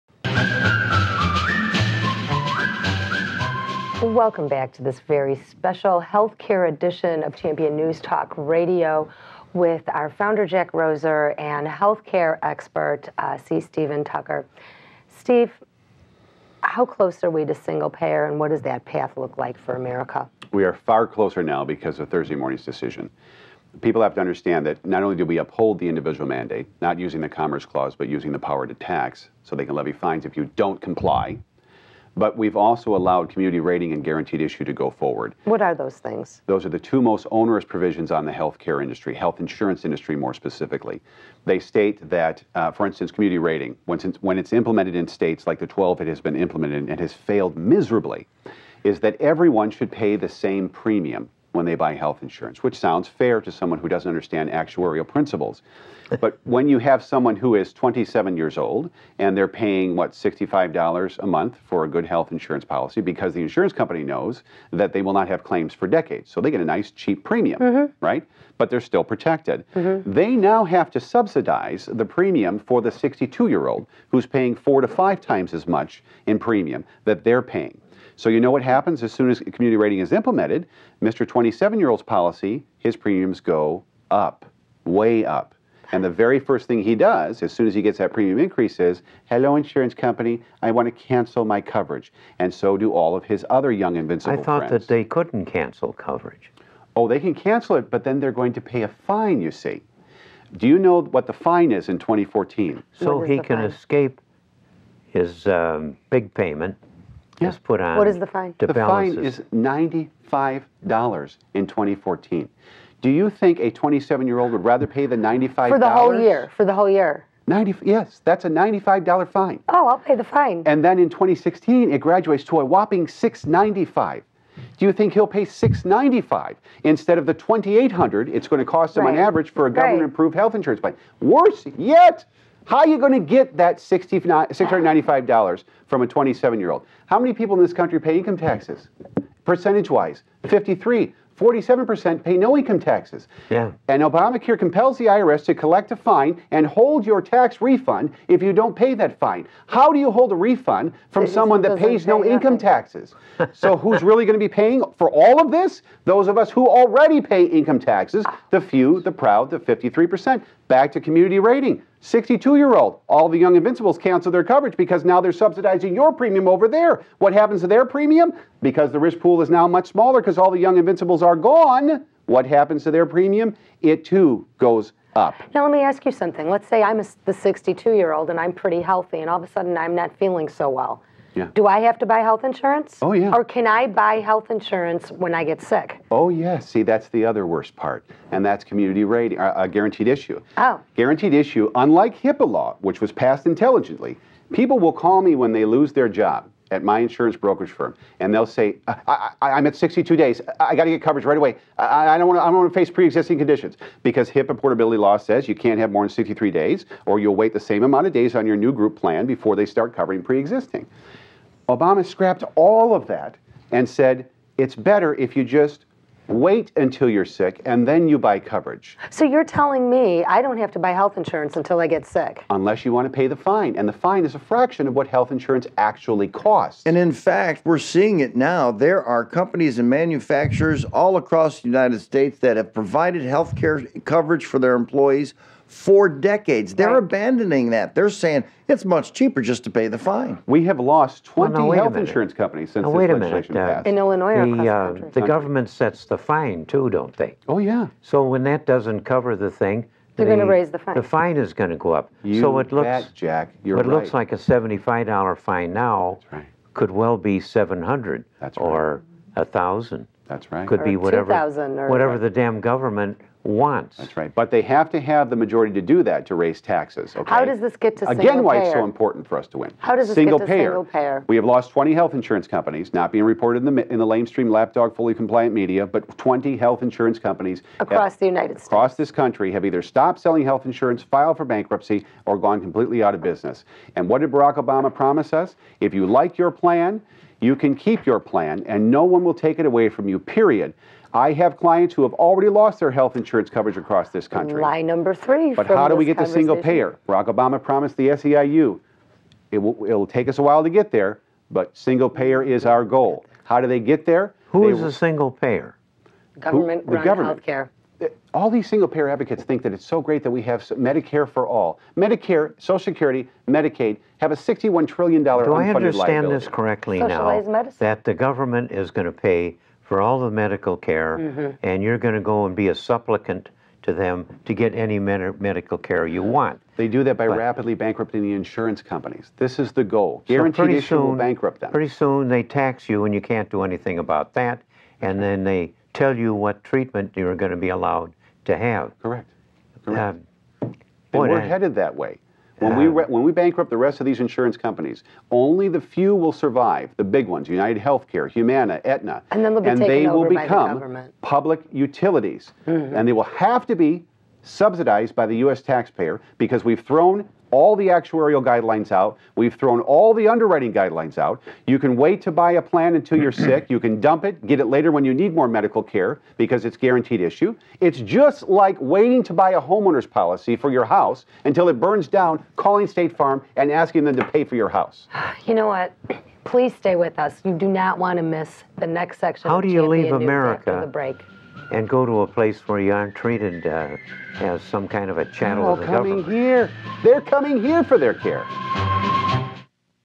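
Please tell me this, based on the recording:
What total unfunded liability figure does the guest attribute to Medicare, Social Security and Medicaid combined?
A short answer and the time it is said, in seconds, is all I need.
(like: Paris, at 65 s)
$61 trillion, at 314 s.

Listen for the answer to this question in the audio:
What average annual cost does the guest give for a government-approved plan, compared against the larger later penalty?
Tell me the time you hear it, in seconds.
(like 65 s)
127 s.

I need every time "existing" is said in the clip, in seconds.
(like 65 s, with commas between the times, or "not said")
202 s, 210 s.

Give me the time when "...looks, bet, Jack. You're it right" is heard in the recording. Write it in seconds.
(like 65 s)
252 s.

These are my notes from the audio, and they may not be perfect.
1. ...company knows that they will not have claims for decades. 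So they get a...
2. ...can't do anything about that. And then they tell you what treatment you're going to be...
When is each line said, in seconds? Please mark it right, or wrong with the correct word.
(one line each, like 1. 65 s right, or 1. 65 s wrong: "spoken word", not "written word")
1. 63 s right
2. 333 s right.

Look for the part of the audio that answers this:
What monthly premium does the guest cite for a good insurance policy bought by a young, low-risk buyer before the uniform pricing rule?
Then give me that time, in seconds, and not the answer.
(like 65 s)
60 s.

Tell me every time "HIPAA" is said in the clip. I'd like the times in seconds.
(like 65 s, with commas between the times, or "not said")
192 s, 204 s.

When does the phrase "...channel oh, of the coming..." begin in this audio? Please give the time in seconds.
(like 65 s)
385 s.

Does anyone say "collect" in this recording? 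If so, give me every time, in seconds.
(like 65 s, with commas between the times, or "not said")
145 s.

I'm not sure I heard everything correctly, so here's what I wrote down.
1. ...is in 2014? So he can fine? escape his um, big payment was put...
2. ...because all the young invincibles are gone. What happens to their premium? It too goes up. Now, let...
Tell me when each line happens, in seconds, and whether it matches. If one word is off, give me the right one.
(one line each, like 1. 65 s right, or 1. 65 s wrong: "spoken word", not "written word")
1. 101 s right
2. 170 s right.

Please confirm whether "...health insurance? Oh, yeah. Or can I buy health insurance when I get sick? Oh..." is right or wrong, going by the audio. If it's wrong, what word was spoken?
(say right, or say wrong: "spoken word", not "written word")
right.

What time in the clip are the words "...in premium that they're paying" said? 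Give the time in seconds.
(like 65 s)
76 s.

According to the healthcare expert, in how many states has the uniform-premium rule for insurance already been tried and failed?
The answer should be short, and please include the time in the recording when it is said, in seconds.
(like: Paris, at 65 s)
12, at 45 s.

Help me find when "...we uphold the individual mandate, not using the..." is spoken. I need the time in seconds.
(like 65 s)
25 s.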